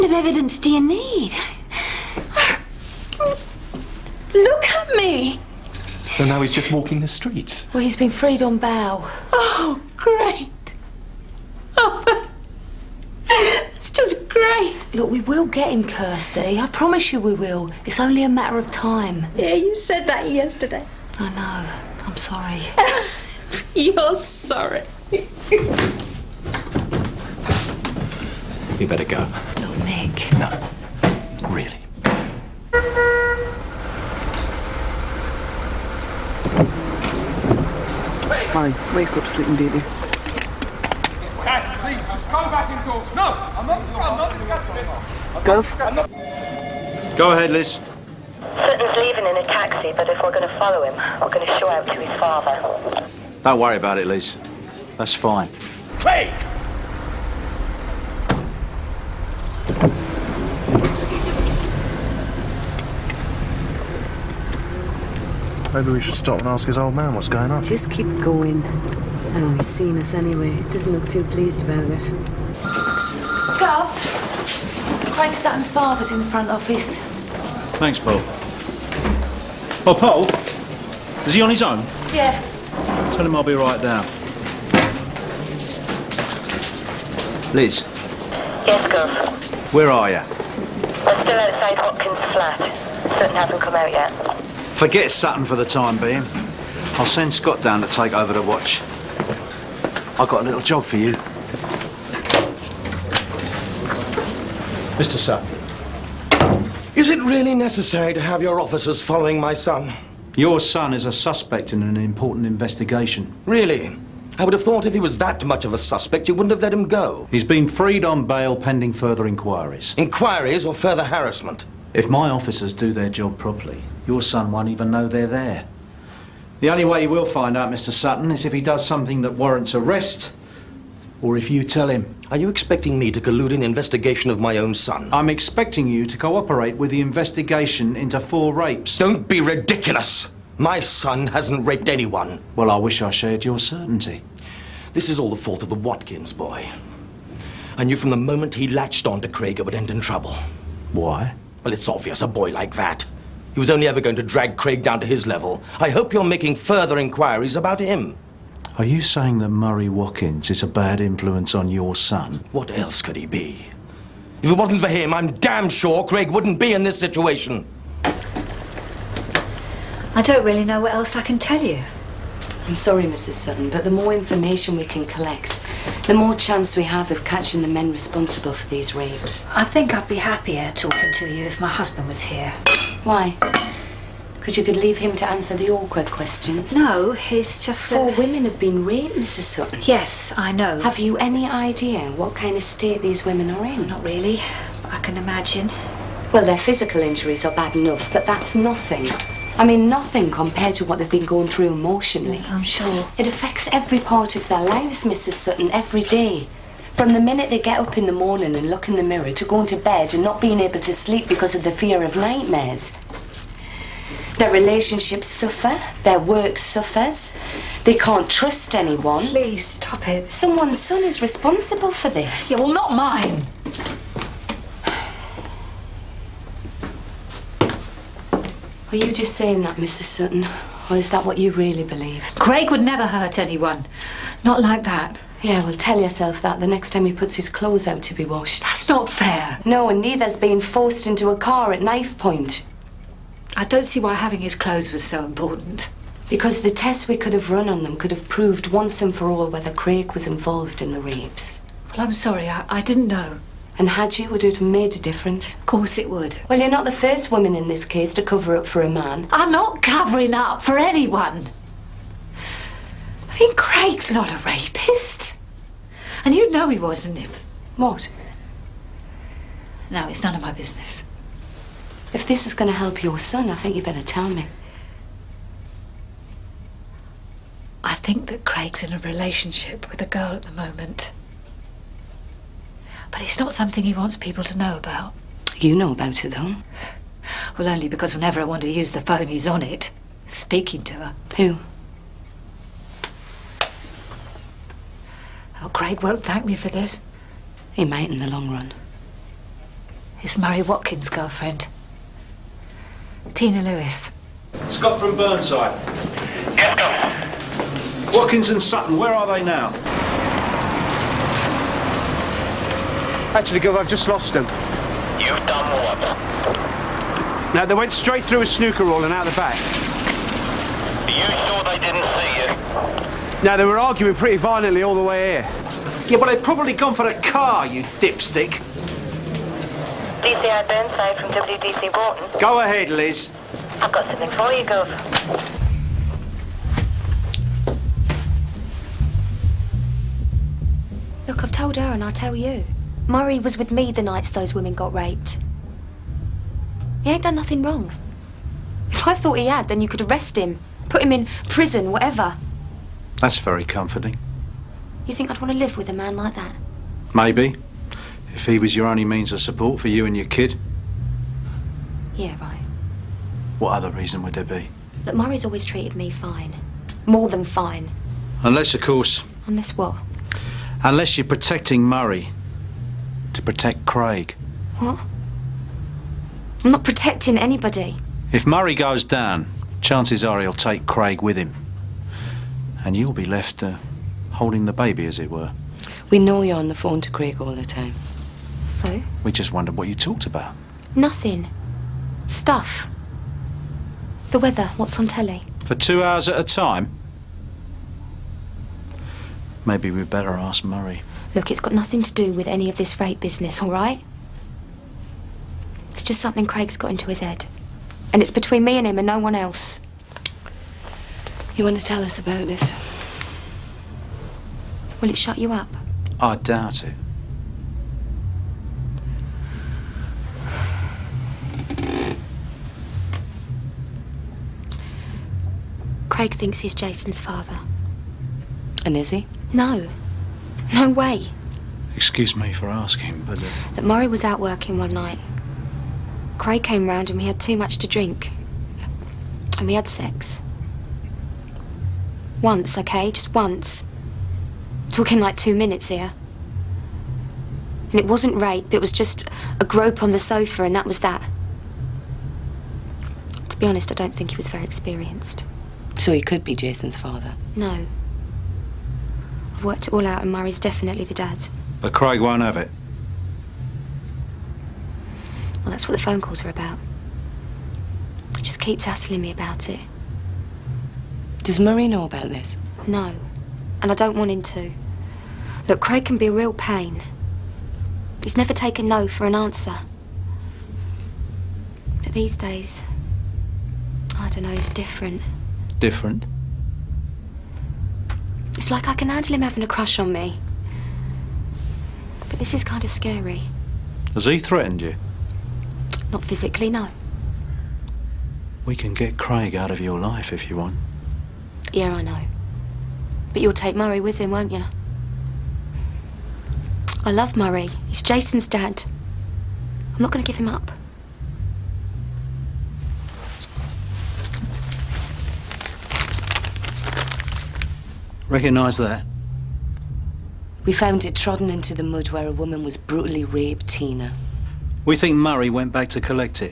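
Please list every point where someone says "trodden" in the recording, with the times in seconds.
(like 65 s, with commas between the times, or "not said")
521 s.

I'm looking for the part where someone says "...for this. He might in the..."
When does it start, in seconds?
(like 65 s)
296 s.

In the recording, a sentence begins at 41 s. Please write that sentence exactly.
Dad, please, just come back indoors.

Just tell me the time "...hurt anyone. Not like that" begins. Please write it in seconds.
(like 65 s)
233 s.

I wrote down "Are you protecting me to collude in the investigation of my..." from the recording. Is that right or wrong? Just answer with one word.
wrong.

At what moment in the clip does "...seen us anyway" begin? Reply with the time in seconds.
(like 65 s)
69 s.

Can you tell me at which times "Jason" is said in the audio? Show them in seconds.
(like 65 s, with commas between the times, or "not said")
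426 s, 456 s, 508 s.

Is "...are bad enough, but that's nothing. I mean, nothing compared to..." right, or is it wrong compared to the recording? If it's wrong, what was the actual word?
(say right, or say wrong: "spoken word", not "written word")
right.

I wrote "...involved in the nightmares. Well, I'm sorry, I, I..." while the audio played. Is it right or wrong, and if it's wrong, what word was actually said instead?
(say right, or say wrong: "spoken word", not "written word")
wrong: "rapes", not "nightmares".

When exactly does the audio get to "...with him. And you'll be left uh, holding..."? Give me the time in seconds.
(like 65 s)
381 s.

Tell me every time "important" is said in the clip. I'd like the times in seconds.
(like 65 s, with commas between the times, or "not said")
111 s, 245 s.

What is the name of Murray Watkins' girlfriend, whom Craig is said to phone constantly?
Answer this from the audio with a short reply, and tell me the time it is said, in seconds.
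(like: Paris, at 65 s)
Tina Lewis, at 303 s.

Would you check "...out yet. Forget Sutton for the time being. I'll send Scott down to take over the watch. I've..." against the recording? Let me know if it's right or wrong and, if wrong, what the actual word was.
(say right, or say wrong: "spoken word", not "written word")
right.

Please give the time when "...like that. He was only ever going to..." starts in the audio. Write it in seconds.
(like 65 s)
152 s.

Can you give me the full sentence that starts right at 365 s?
Look, Murray's always treated me fine.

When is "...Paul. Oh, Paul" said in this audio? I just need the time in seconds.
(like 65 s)
77 s.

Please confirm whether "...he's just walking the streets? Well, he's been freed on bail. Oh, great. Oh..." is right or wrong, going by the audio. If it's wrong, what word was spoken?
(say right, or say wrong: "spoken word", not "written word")
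right.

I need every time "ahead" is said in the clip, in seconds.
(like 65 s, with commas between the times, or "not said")
47 s, 332 s.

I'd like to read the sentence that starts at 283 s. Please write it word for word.
But it's not something he wants people to know about.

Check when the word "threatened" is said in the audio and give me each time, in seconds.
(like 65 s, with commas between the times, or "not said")
494 s.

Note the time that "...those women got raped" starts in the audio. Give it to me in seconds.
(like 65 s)
344 s.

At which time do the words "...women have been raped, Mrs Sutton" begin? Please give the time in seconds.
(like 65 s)
188 s.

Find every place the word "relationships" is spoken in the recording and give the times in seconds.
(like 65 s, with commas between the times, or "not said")
214 s, 278 s.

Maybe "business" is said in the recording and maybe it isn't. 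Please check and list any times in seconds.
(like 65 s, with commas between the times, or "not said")
270 s, 403 s.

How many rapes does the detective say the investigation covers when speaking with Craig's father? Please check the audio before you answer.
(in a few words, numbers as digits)
4.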